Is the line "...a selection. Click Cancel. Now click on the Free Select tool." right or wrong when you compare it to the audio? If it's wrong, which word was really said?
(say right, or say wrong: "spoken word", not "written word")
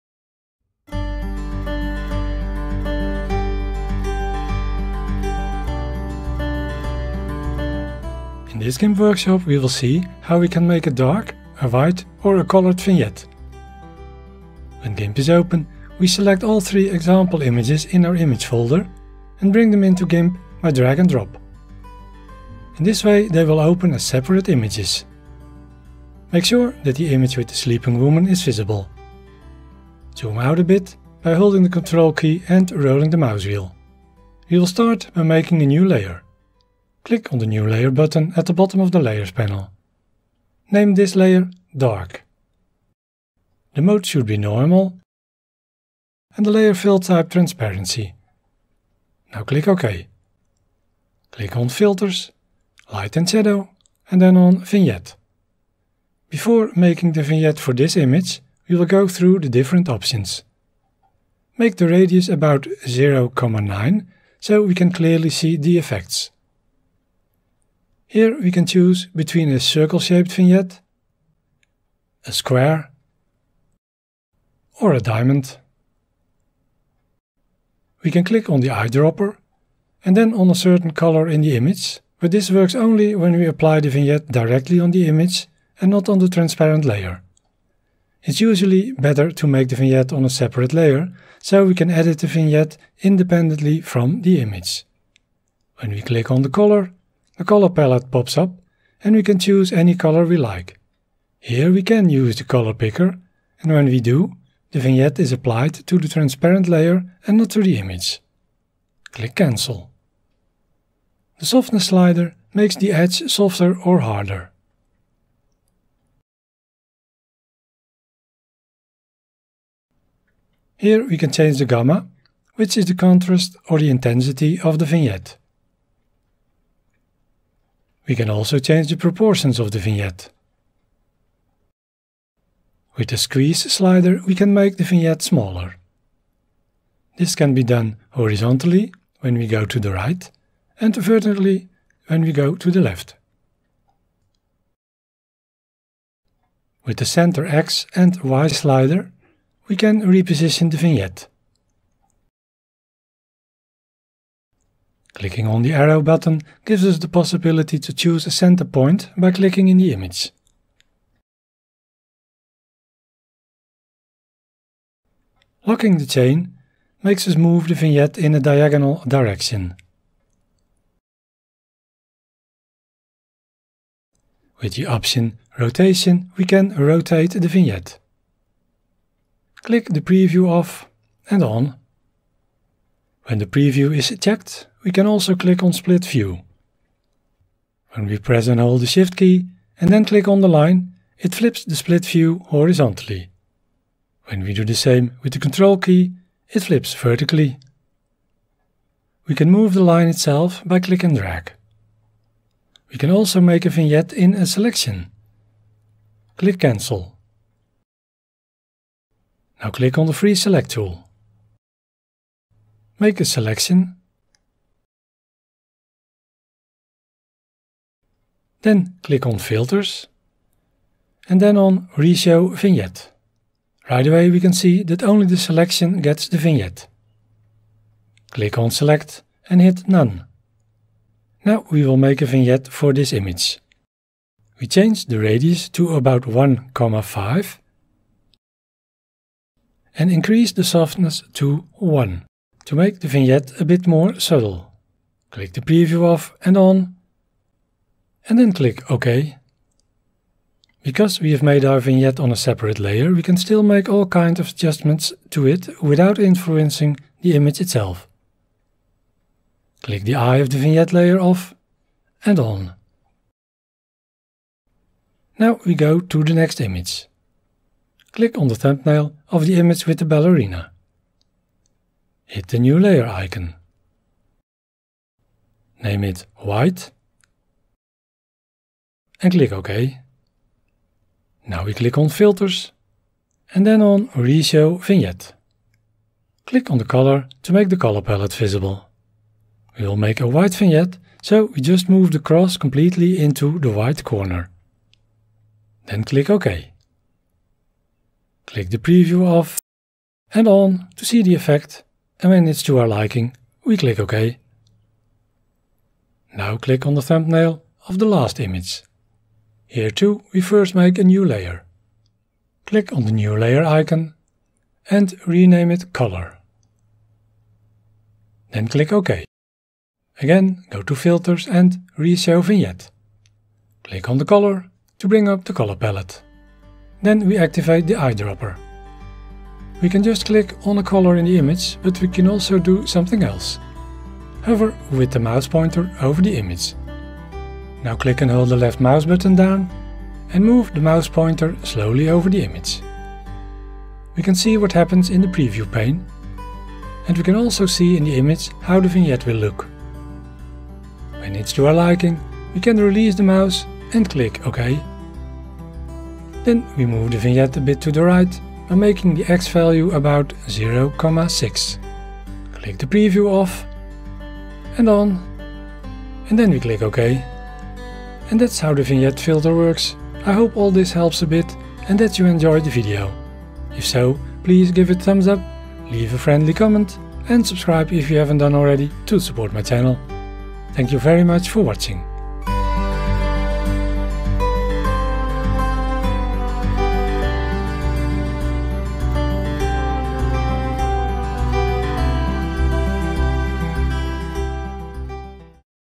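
right.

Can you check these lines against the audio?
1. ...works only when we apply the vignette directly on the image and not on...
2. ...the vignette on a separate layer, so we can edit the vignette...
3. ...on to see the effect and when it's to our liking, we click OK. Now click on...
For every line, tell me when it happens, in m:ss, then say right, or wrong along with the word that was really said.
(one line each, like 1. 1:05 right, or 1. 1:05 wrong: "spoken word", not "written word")
1. 1:22 right
2. 1:29 right
3. 5:00 right.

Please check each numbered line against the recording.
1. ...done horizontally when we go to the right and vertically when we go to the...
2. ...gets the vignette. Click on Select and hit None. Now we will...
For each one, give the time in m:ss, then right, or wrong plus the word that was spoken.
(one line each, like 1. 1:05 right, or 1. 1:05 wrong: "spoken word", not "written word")
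1. 2:17 right
2. 3:46 right.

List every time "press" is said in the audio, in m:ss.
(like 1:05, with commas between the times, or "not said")
3:08.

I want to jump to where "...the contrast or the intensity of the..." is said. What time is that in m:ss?
2:02.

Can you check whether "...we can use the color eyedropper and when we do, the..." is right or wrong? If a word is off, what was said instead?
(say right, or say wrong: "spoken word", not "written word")
wrong: "picker", not "eyedropper".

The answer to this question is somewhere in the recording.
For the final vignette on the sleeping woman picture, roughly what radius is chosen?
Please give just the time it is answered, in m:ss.
3:56.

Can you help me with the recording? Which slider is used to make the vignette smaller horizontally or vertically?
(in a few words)
squeeze.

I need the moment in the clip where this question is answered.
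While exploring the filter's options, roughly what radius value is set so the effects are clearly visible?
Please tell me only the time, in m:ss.
1:02.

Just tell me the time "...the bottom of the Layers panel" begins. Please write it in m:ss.
0:38.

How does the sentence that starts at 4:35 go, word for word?
Name it White and click OK.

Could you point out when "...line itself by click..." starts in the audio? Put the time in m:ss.
3:19.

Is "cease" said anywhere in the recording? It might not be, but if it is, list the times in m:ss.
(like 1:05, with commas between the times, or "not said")
not said.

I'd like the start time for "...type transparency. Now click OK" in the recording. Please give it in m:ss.
0:46.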